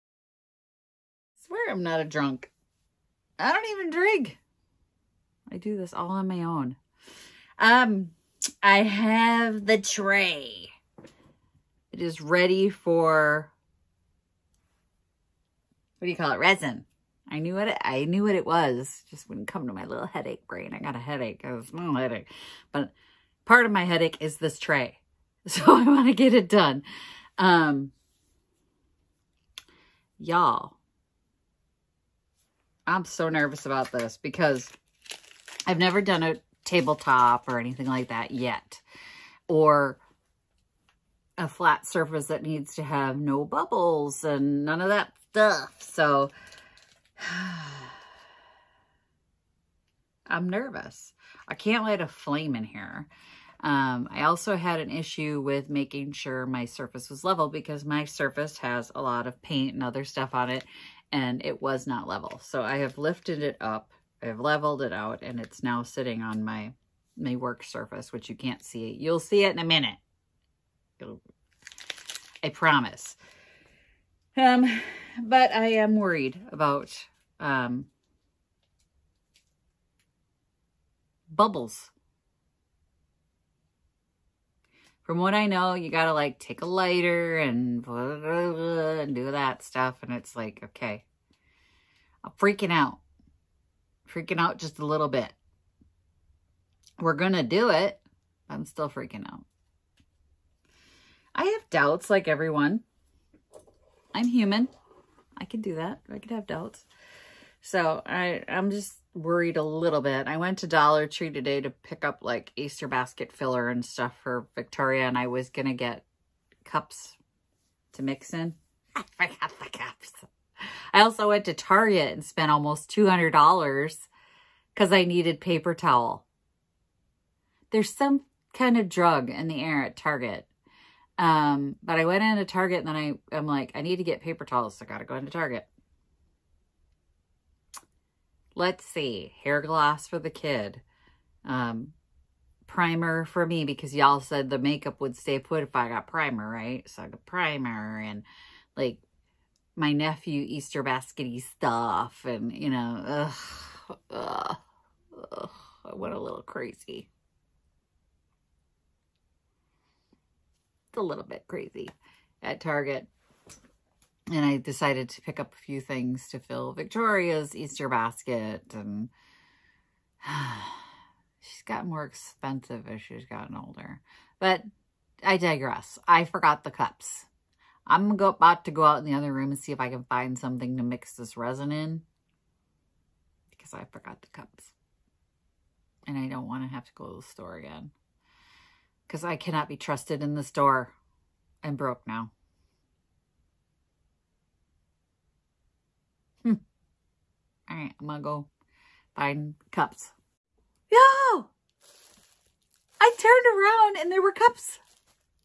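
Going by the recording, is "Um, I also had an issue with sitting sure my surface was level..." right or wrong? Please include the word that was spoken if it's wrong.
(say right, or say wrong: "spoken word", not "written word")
wrong: "making", not "sitting".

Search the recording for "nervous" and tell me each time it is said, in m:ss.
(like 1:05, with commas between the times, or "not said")
0:33, 0:50.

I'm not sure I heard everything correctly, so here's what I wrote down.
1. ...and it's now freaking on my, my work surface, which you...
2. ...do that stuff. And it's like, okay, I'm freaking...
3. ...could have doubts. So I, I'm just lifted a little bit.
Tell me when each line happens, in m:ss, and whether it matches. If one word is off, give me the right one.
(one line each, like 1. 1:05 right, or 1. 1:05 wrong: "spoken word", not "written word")
1. 1:05 wrong: "sitting", not "freaking"
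2. 1:29 right
3. 1:46 wrong: "worried", not "lifted".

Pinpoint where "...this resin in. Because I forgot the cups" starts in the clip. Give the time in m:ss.
3:01.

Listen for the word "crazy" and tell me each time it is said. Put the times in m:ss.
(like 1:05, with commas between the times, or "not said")
2:36, 2:41.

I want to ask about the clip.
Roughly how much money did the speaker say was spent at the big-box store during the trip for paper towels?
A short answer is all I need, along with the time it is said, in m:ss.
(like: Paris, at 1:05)
$200, at 2:02.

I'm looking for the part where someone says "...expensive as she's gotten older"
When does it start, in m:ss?
2:52.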